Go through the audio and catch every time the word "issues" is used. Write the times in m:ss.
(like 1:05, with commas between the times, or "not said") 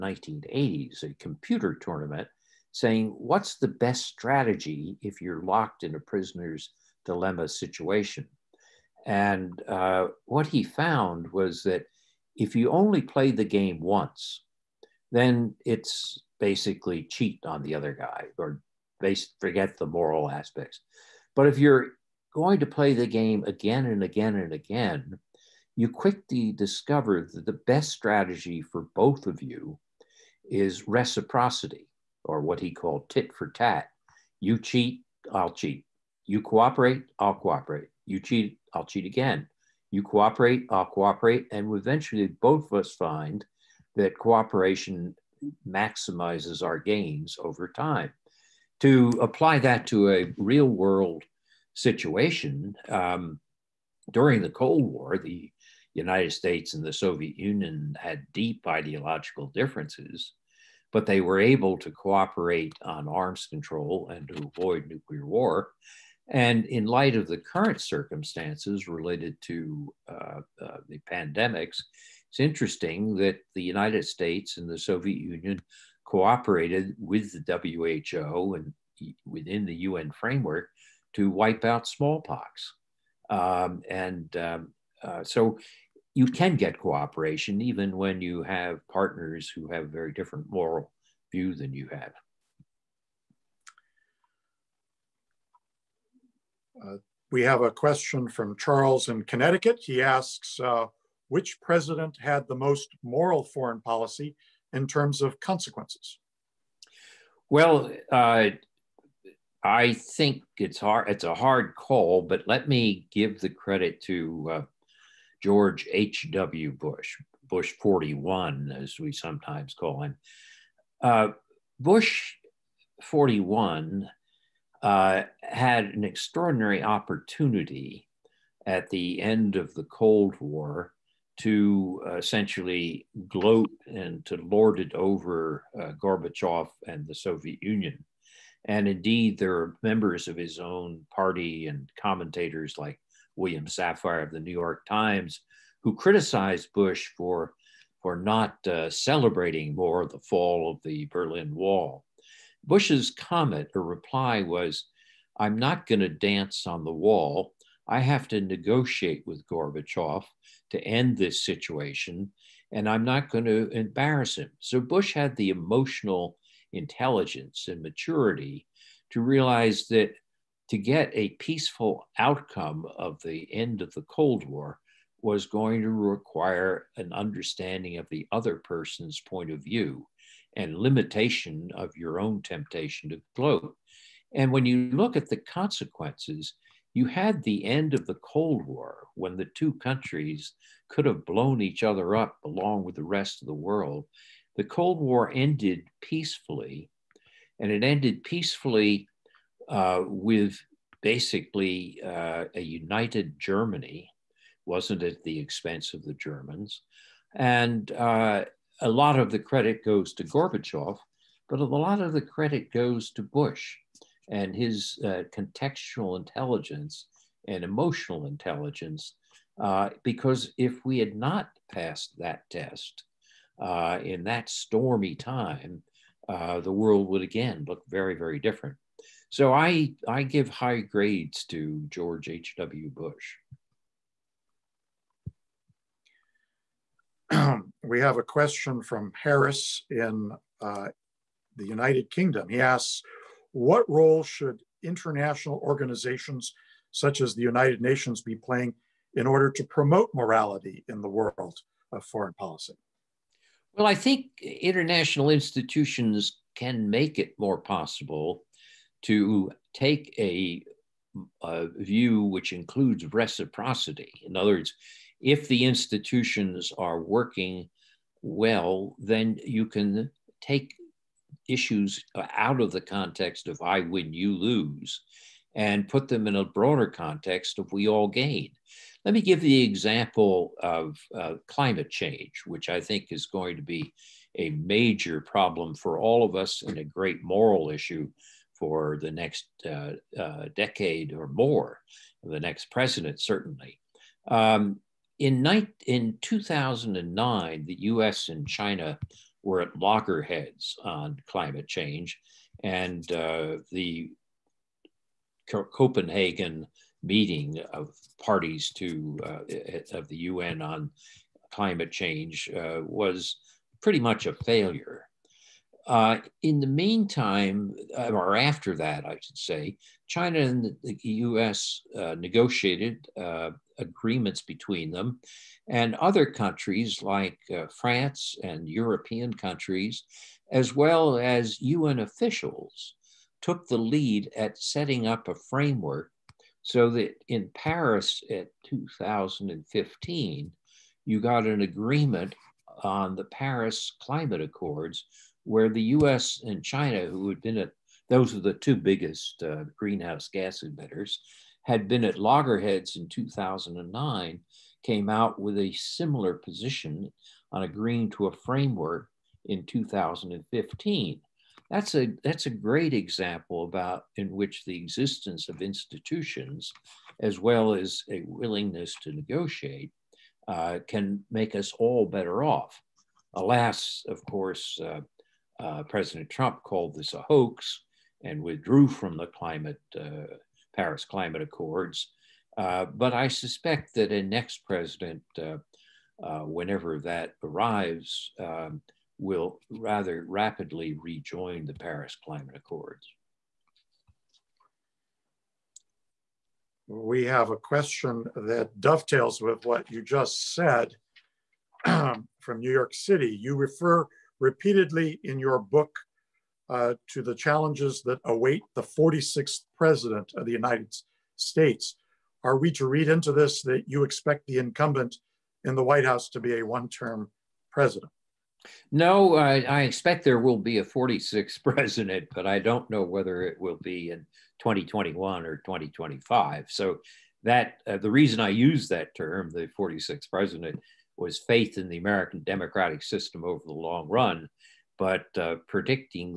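4:31, 4:47.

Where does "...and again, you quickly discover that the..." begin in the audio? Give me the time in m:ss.
0:24.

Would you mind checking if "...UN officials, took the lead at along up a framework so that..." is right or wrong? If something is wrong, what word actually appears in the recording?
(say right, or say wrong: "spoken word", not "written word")
wrong: "setting", not "along".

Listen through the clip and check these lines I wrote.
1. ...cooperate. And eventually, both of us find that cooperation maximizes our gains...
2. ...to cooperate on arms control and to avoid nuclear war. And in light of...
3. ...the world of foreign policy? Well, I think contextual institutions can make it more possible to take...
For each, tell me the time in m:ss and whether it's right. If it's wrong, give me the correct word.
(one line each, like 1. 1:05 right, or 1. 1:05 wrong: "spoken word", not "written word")
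1. 0:40 right
2. 1:01 right
3. 4:11 wrong: "international", not "contextual".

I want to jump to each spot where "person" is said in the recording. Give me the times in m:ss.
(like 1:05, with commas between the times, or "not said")
2:58.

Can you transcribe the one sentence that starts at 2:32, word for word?
Bush's comment or reply was, I'm not going to dance on the wall.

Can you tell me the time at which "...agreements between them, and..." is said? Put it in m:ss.
5:23.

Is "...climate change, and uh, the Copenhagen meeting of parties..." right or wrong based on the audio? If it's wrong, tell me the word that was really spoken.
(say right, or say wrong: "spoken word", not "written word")
right.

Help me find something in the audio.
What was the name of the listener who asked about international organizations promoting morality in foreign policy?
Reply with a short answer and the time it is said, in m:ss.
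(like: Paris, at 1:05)
Harris, at 3:59.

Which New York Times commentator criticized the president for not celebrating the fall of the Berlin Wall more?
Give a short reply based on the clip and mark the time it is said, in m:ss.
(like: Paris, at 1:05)
William Safire, at 2:23.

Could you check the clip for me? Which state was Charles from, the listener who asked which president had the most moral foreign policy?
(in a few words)
Connecticut.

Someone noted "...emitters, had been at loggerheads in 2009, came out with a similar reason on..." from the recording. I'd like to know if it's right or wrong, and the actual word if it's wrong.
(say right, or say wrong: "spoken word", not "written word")
wrong: "position", not "reason".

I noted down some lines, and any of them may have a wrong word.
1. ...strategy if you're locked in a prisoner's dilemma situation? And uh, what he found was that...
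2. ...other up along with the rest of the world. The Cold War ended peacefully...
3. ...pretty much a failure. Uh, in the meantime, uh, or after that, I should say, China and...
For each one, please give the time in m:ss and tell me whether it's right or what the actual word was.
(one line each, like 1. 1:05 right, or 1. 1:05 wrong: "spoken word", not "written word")
1. 0:04 right
2. 3:11 right
3. 5:13 right.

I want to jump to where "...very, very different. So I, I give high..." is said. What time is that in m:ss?
3:47.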